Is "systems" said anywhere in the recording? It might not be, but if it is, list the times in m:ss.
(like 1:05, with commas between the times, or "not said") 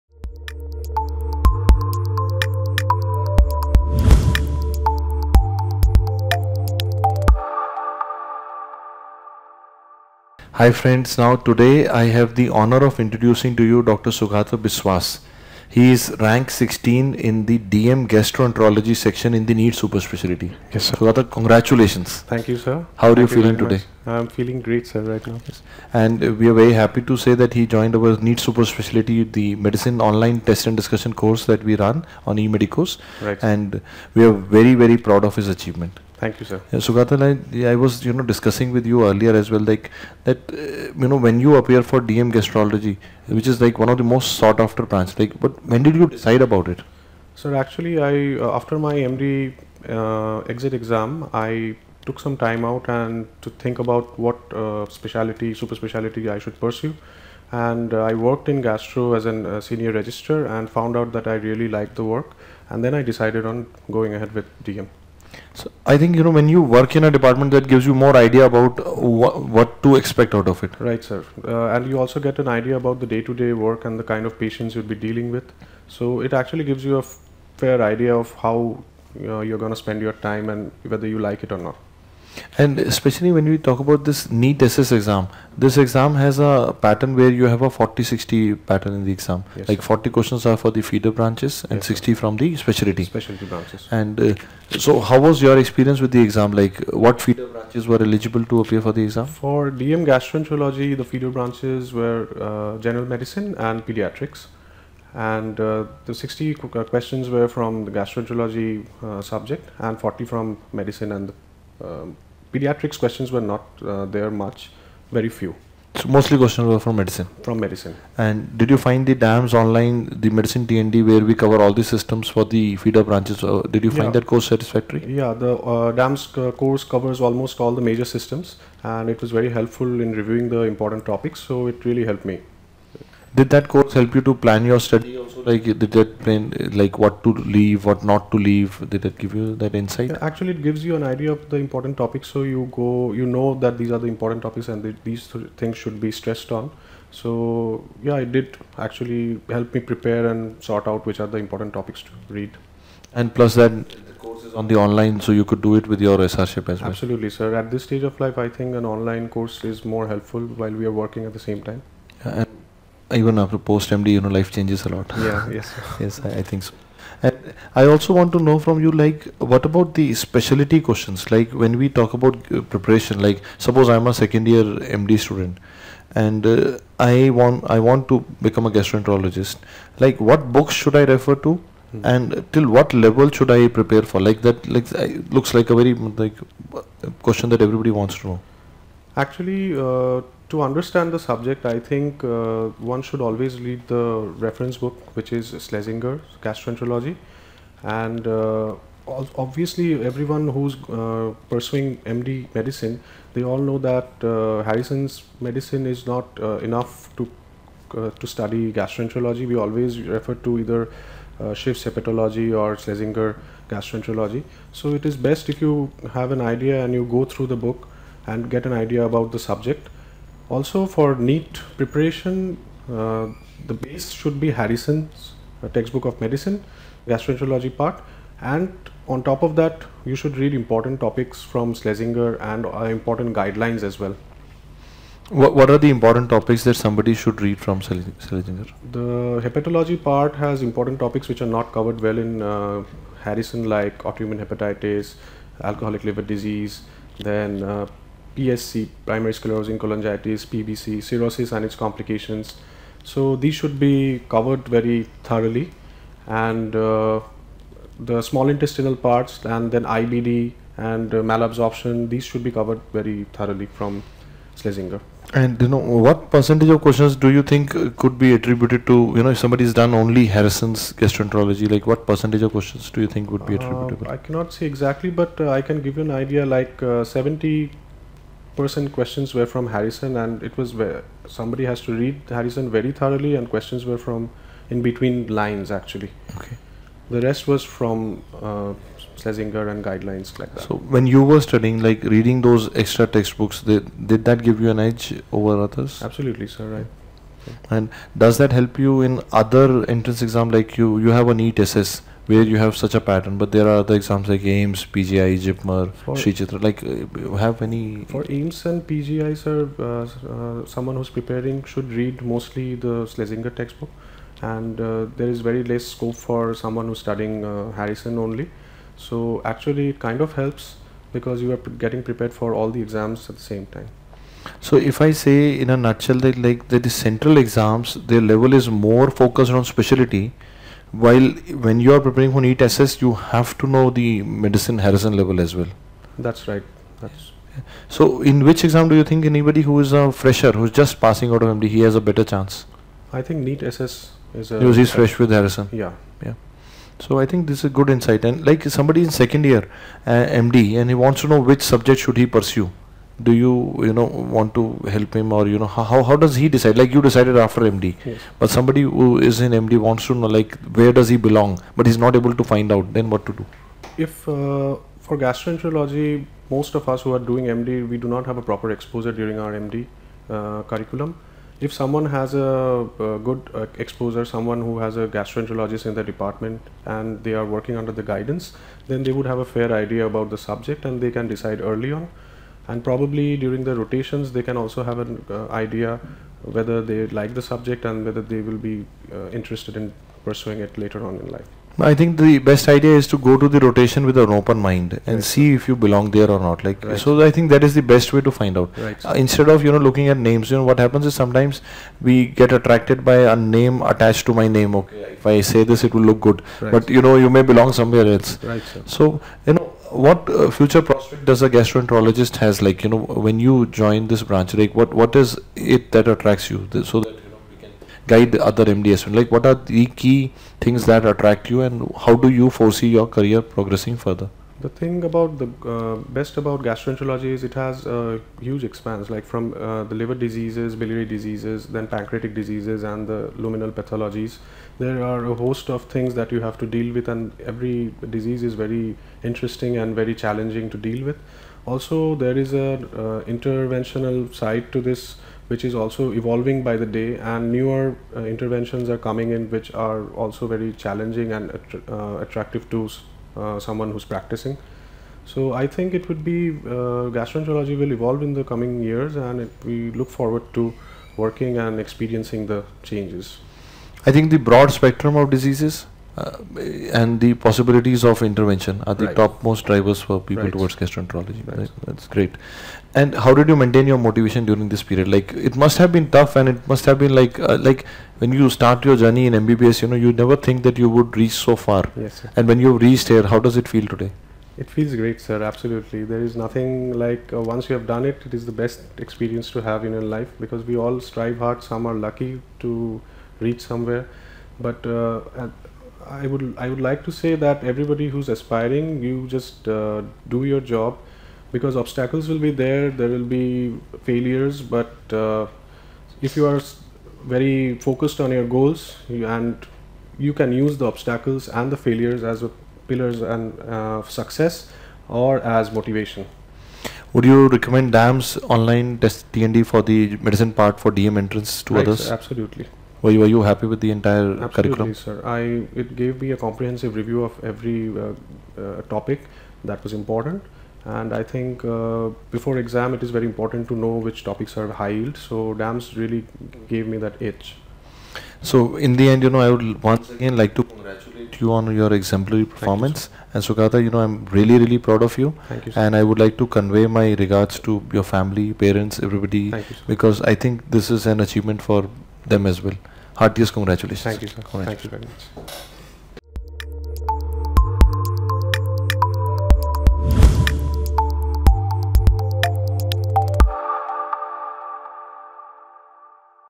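2:01, 2:08.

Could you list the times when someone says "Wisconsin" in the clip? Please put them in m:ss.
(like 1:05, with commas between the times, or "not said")
not said.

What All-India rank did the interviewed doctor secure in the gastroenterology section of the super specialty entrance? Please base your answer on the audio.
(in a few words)
16.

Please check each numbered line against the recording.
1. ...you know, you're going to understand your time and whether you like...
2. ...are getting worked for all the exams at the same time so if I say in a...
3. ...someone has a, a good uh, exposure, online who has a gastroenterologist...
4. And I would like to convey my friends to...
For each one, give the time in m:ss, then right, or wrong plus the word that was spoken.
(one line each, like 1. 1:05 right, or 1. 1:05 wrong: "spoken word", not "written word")
1. 1:19 wrong: "spend", not "understand"
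2. 5:21 wrong: "prepared", not "worked"
3. 6:11 wrong: "someone", not "online"
4. 9:05 wrong: "regards", not "friends".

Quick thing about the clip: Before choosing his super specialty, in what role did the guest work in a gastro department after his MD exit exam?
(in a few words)
Senior registrar.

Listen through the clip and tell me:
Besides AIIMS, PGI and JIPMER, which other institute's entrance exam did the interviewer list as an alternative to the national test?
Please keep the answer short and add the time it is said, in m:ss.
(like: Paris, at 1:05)
Shri Chitra, at 5:06.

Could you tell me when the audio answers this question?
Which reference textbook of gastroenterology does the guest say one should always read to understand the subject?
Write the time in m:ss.
3:15.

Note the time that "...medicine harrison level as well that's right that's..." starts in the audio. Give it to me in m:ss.
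5:34.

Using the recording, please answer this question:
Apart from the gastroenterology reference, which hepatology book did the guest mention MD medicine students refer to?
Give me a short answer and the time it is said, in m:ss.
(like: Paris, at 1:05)
Schiff's hepatology, at 3:31.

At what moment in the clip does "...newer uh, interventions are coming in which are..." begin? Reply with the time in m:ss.
7:27.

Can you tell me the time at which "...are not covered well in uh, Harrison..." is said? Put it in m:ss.
4:01.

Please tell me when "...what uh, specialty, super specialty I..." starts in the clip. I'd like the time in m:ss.
0:54.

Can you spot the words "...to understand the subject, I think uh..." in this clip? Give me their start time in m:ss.
3:10.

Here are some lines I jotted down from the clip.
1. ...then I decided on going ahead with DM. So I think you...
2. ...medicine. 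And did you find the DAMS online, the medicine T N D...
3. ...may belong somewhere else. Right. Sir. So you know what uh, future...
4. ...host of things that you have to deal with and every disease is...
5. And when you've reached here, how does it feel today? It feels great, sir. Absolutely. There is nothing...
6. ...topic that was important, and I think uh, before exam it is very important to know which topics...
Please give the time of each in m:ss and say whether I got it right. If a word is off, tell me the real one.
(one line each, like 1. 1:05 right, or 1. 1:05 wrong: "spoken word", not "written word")
1. 1:02 right
2. 1:57 right
3. 6:47 right
4. 7:15 right
5. 8:02 right
6. 8:48 right.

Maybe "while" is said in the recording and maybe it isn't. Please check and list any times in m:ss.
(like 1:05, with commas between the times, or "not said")
2:40, 5:30.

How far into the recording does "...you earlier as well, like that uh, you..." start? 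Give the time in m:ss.
0:38.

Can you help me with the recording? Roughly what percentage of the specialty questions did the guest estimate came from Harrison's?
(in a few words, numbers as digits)
70 percent.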